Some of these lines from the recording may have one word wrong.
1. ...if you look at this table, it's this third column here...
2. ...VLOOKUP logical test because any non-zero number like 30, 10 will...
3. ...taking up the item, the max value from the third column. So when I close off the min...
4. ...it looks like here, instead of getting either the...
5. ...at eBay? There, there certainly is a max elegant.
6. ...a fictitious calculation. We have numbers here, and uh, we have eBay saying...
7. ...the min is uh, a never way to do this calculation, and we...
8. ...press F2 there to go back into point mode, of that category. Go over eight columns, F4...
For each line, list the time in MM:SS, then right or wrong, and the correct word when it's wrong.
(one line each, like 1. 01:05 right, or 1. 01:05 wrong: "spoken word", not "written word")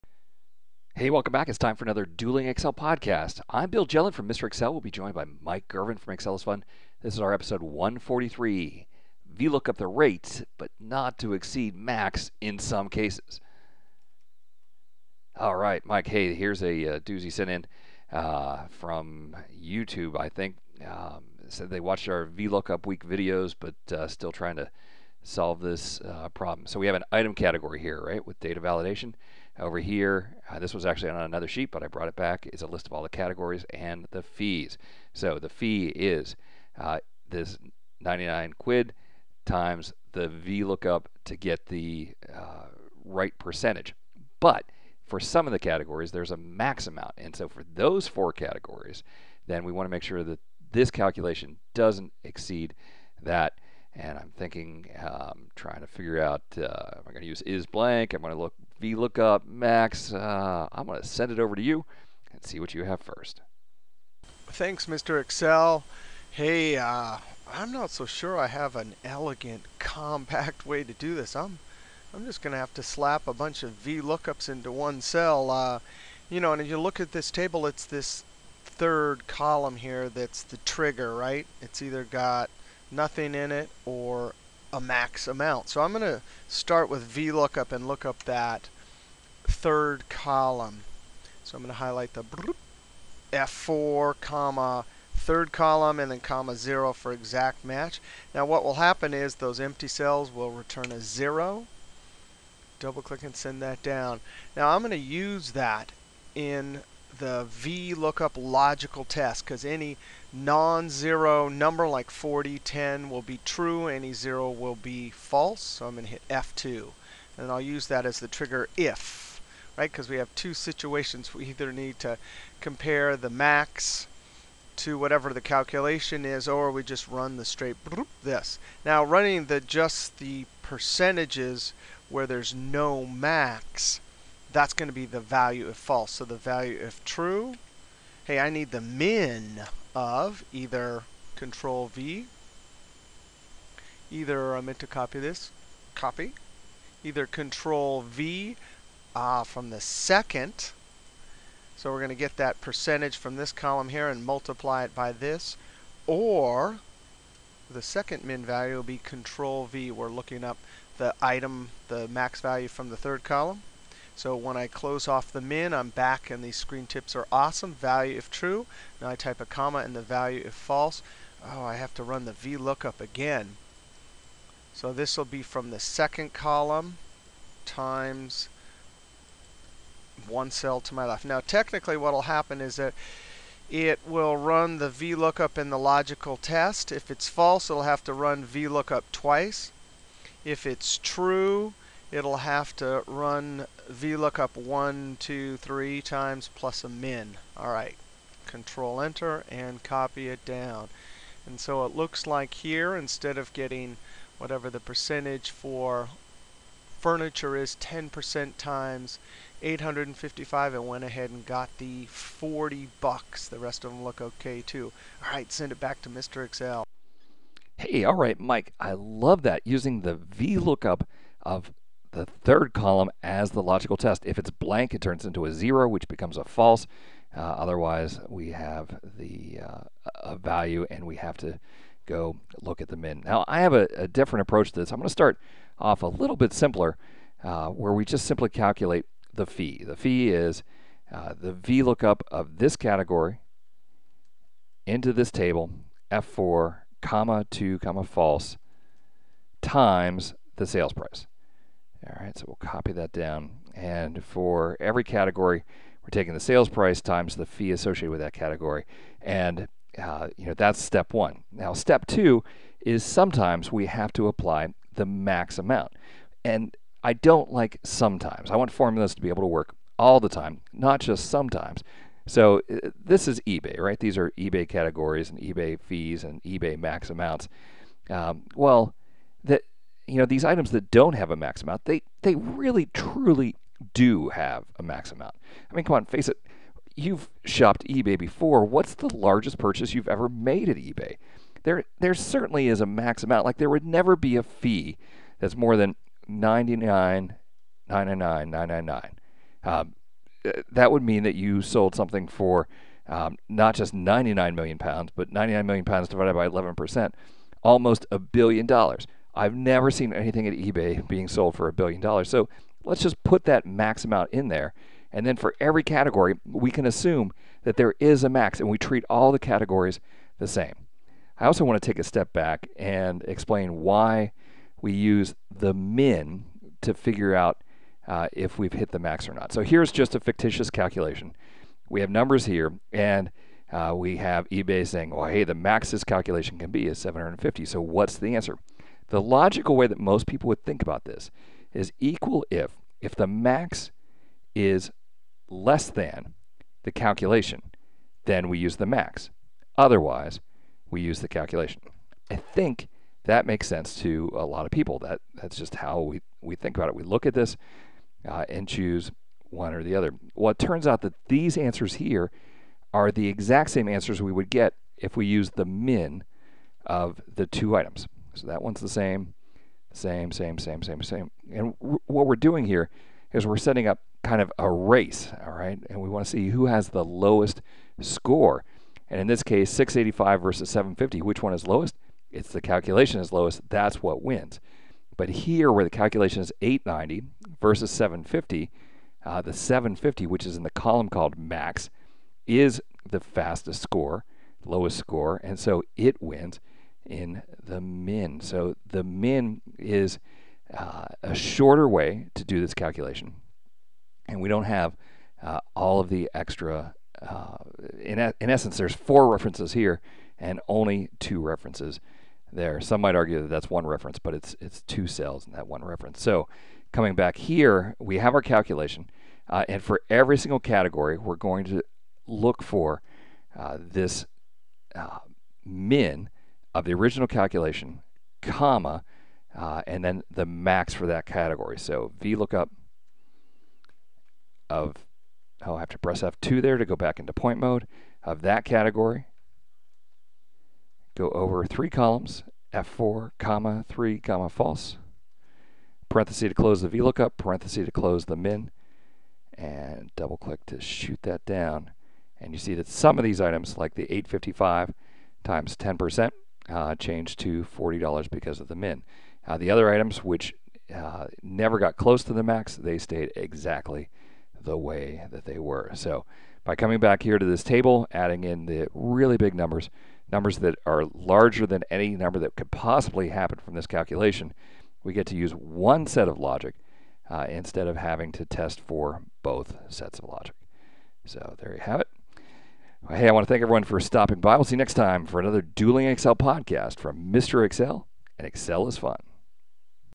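1. 01:16 right
2. 01:47 wrong: "40", not "30"
3. 02:40 wrong: "looking", not "taking"
4. 03:21 wrong: "whatever", not "either"
5. 04:50 wrong: "amount", not "elegant"
6. 05:30 right
7. 06:38 wrong: "shorter", not "never"
8. 07:15 wrong: "three", not "eight".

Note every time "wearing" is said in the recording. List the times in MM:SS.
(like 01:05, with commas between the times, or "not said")
not said.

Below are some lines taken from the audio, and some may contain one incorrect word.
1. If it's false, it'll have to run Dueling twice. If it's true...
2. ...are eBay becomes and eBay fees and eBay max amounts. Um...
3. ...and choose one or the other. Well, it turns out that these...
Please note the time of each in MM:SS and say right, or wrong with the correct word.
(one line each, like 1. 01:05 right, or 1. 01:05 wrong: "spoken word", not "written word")
1. 03:06 wrong: "VLOOKUP", not "Dueling"
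2. 04:34 wrong: "categories", not "becomes"
3. 05:58 right.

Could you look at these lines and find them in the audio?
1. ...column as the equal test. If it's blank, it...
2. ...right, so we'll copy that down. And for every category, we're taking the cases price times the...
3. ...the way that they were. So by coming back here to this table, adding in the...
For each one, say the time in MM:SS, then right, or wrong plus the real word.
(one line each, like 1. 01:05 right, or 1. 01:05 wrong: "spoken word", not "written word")
1. 03:42 wrong: "logical", not "equal"
2. 04:12 wrong: "sales", not "cases"
3. 07:44 right.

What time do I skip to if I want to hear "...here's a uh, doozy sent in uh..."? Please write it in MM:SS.
00:16.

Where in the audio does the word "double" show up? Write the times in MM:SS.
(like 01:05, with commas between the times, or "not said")
01:42, 07:30.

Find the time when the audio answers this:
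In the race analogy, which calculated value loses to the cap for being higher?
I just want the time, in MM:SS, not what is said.
06:26.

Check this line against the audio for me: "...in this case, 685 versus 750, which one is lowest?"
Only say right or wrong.
right.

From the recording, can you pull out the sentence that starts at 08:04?
We'll see you next time for another Dueling Excel podcast from Mr.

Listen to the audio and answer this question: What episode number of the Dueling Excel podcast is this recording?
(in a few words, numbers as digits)
143.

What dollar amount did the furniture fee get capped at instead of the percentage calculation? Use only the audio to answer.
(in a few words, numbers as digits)
40.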